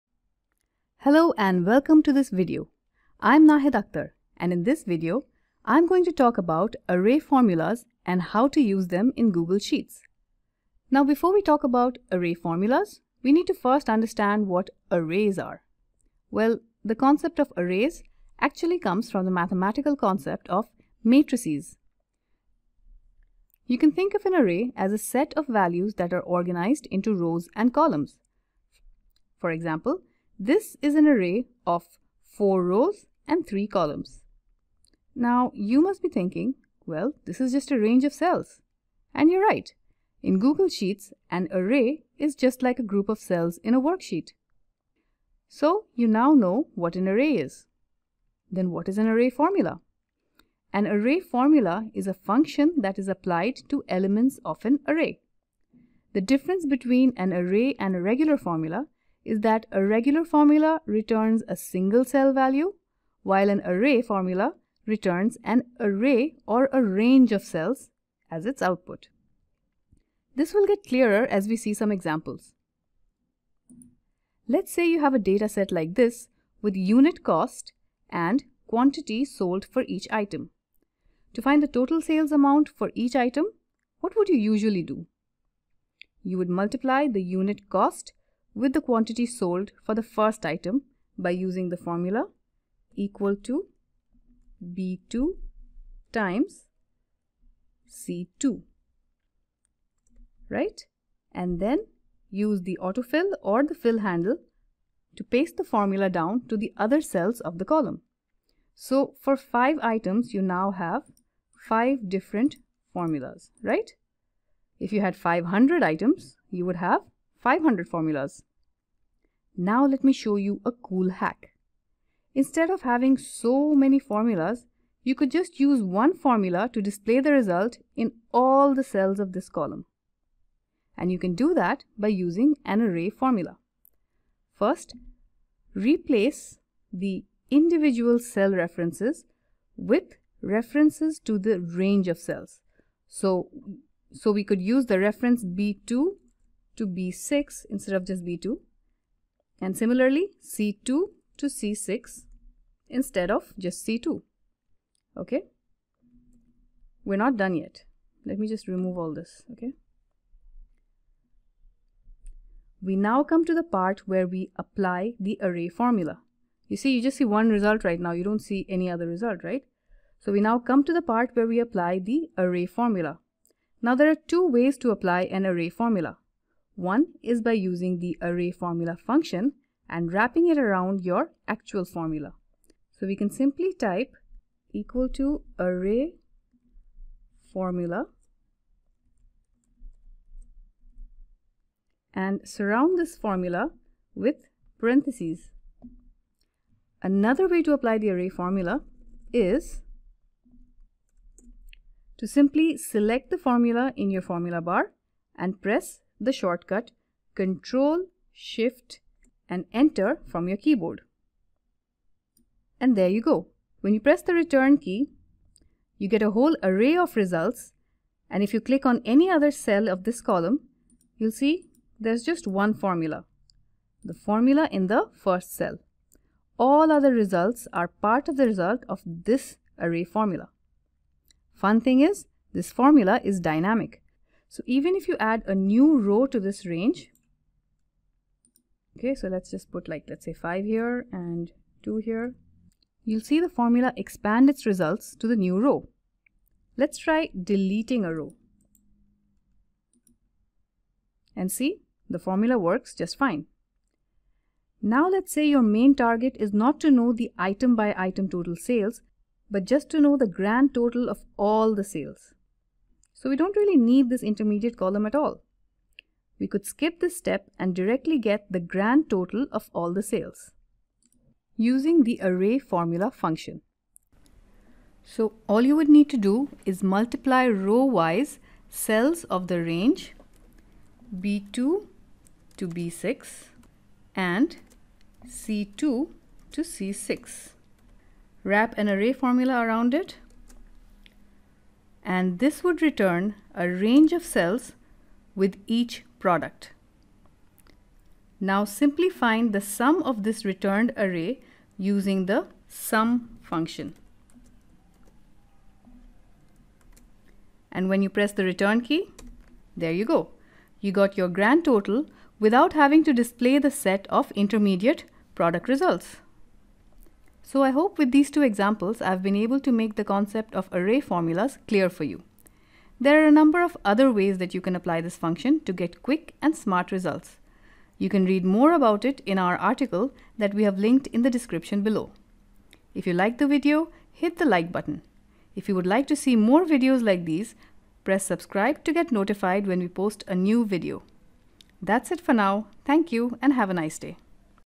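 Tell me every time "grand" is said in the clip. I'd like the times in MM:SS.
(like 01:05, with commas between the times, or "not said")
04:20, 04:28, 05:11.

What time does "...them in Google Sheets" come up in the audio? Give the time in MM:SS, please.
00:08.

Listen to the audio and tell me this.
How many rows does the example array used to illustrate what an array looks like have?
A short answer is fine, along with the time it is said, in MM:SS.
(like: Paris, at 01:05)
4, at 00:32.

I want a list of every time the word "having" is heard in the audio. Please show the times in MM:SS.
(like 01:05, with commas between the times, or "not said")
02:02, 05:12.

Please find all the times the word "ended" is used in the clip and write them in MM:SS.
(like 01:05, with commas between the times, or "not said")
not said.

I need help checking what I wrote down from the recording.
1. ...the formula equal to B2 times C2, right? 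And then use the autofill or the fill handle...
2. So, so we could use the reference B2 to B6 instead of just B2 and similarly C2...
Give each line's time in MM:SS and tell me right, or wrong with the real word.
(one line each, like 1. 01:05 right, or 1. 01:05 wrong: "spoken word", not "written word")
1. 01:31 right
2. 02:23 right.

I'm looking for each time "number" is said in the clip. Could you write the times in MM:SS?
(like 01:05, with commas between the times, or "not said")
05:23.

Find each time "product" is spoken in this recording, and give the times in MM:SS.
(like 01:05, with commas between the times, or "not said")
04:56, 05:15.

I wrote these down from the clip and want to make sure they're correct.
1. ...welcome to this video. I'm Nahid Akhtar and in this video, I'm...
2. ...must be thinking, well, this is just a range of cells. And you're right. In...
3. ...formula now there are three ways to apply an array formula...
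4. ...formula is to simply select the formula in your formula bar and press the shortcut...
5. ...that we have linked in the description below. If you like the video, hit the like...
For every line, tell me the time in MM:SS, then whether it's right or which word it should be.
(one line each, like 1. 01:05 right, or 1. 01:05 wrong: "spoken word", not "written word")
1. 00:01 right
2. 00:35 right
3. 02:52 wrong: "two", not "three"
4. 03:18 right
5. 05:30 right.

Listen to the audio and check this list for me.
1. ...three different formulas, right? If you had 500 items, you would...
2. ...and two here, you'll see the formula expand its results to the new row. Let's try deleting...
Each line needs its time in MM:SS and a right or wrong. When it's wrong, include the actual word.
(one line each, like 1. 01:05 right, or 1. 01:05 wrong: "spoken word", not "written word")
1. 01:51 wrong: "five", not "three"
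2. 04:01 right.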